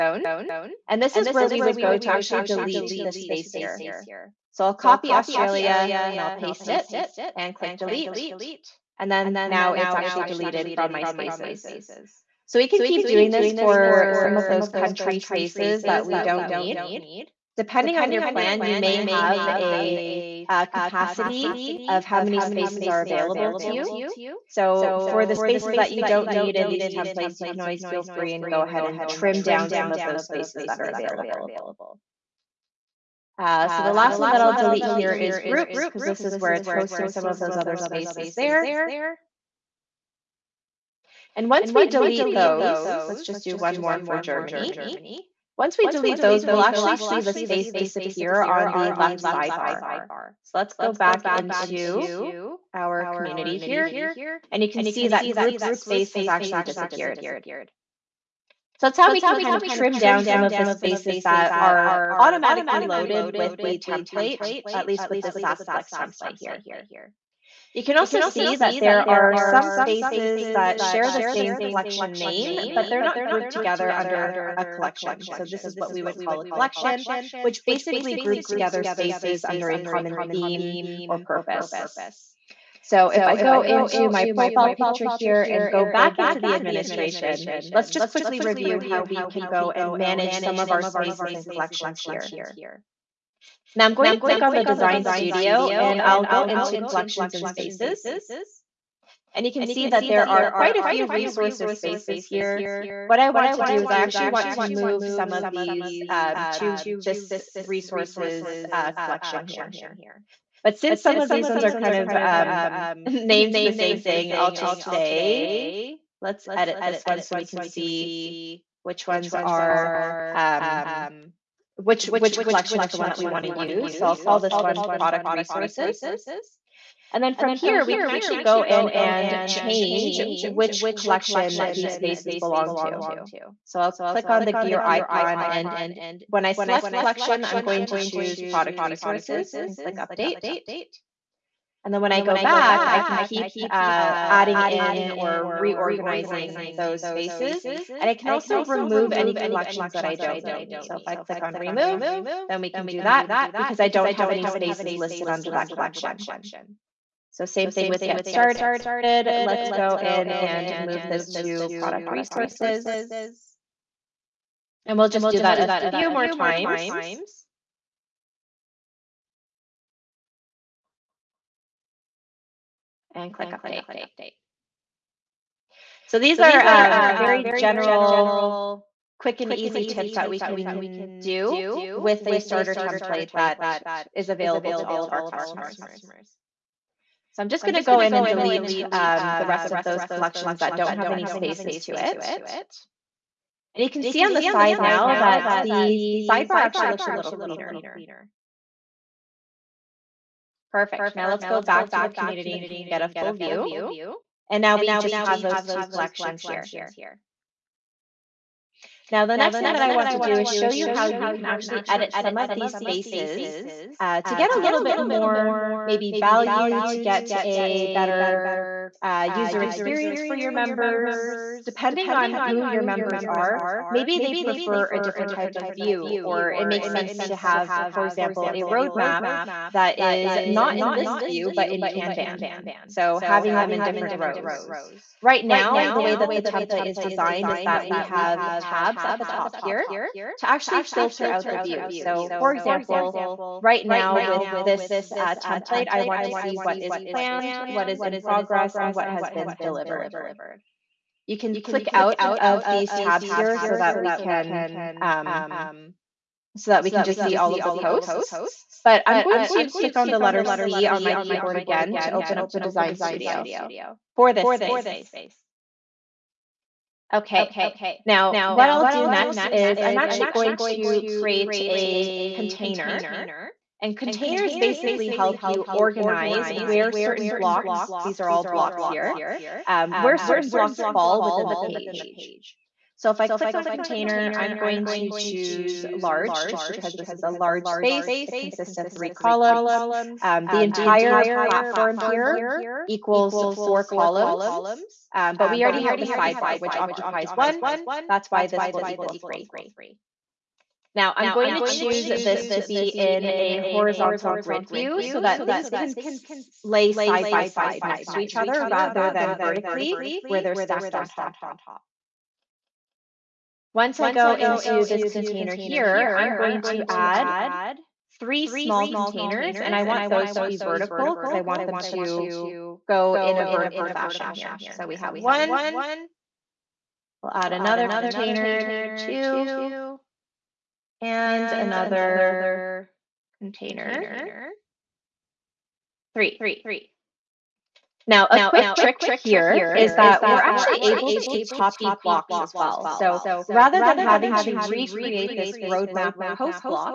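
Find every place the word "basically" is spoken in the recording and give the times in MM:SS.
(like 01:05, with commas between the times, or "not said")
01:17, 04:34.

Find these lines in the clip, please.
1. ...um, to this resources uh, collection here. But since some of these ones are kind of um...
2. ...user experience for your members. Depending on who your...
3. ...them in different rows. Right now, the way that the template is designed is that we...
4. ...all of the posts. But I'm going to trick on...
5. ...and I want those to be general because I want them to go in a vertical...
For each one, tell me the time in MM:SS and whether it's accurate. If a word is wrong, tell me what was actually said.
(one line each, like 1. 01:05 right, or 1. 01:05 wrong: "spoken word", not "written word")
1. 01:46 right
2. 03:39 right
3. 03:53 right
4. 04:17 wrong: "click", not "trick"
5. 05:19 wrong: "vertical", not "general".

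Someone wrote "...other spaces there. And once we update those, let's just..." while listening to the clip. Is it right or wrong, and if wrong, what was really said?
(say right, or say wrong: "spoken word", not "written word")
wrong: "delete", not "update".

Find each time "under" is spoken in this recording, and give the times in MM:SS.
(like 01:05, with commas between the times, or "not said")
01:13, 01:19, 02:35.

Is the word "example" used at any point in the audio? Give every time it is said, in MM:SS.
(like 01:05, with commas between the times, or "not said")
03:48, 04:02.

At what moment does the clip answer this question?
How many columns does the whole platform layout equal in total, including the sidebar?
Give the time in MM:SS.
04:53.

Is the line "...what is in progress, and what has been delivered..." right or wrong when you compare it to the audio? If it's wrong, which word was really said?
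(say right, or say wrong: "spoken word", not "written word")
right.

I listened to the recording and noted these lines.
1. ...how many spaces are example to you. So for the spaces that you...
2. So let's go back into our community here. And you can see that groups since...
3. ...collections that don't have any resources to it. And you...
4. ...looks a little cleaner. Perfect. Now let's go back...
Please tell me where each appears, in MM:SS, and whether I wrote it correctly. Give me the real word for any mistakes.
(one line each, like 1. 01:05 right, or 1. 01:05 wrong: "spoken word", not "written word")
1. 00:22 wrong: "available", not "example"
2. 00:50 wrong: "space", not "since"
3. 03:10 wrong: "spaces", not "resources"
4. 03:16 right.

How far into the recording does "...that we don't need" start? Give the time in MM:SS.
00:15.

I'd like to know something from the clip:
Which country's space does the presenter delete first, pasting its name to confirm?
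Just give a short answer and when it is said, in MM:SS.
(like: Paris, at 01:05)
Australia, at 00:05.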